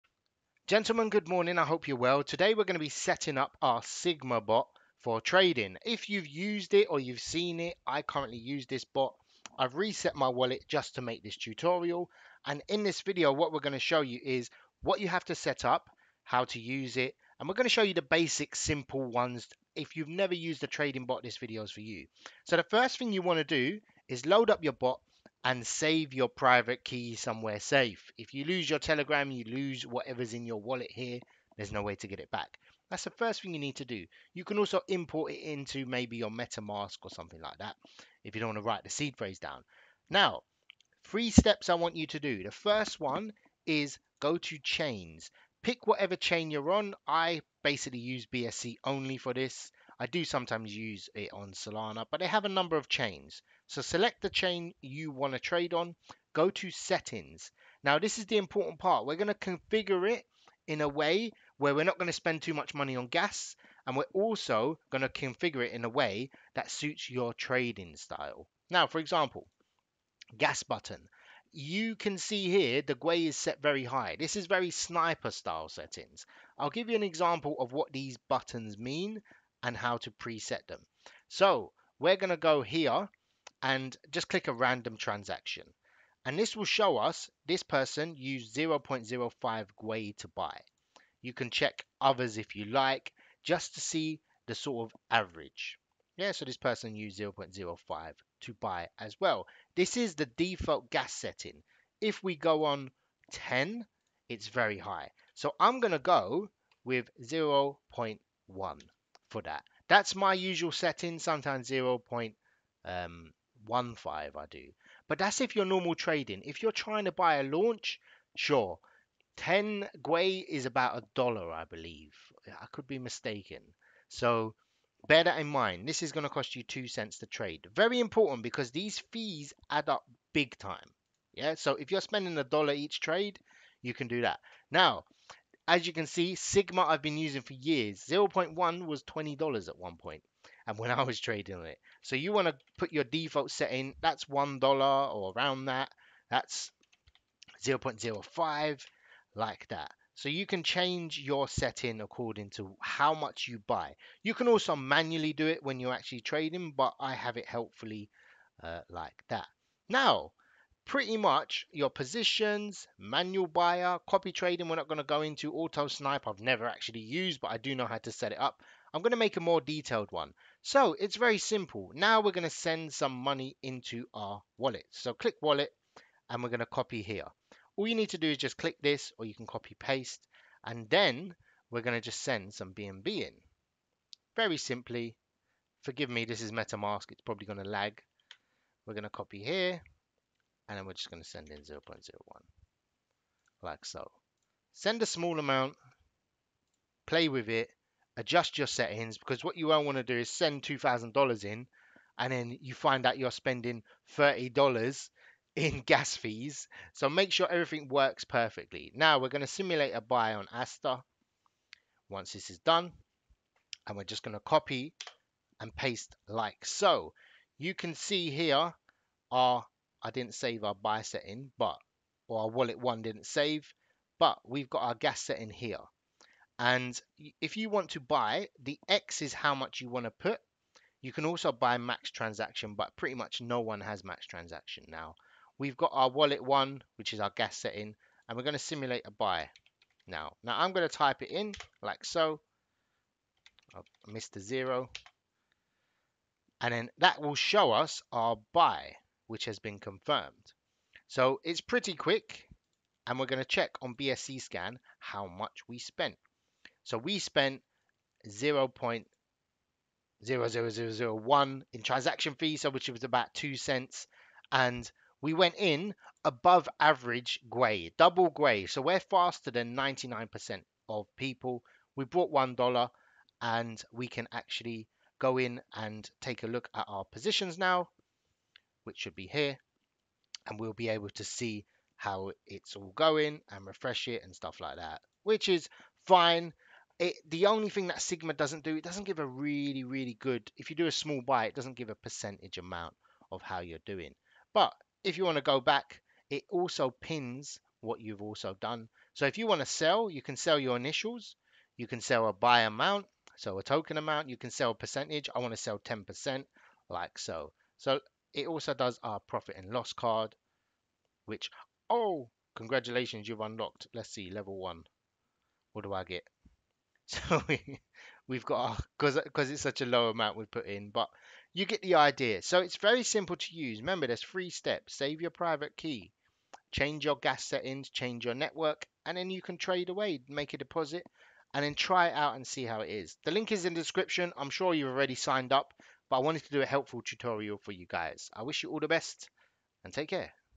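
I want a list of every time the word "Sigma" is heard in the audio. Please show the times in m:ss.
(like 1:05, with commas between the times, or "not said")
0:03, 2:16, 4:48.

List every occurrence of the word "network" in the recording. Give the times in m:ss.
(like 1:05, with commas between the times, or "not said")
5:28.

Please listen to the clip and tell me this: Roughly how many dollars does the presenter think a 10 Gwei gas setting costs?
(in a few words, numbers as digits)
$1.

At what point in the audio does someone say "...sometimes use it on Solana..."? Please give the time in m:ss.
0:50.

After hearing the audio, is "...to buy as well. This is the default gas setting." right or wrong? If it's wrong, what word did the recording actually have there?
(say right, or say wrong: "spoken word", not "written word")
right.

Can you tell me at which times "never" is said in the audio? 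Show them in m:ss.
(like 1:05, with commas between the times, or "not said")
0:20, 2:46.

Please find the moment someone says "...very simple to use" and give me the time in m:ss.
5:22.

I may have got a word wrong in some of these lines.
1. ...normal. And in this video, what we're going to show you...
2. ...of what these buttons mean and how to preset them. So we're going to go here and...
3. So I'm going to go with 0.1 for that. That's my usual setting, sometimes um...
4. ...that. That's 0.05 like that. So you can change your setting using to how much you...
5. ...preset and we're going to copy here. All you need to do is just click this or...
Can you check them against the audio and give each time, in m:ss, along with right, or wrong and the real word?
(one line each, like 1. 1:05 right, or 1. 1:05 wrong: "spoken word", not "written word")
1. 0:11 wrong: "tutorial", not "normal"
2. 1:17 right
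3. 1:45 right
4. 2:25 wrong: "according", not "using"
5. 2:55 wrong: "wallet", not "preset".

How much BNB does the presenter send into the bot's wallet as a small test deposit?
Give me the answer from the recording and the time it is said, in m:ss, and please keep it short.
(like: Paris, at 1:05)
0.01, at 3:11.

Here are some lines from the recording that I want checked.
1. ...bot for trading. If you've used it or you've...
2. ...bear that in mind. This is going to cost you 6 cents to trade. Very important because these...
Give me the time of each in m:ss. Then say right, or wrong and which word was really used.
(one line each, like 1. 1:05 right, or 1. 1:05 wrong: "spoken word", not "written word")
1. 0:04 right
2. 2:05 wrong: "2", not "6".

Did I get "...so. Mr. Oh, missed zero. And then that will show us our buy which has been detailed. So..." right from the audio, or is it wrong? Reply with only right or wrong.
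wrong.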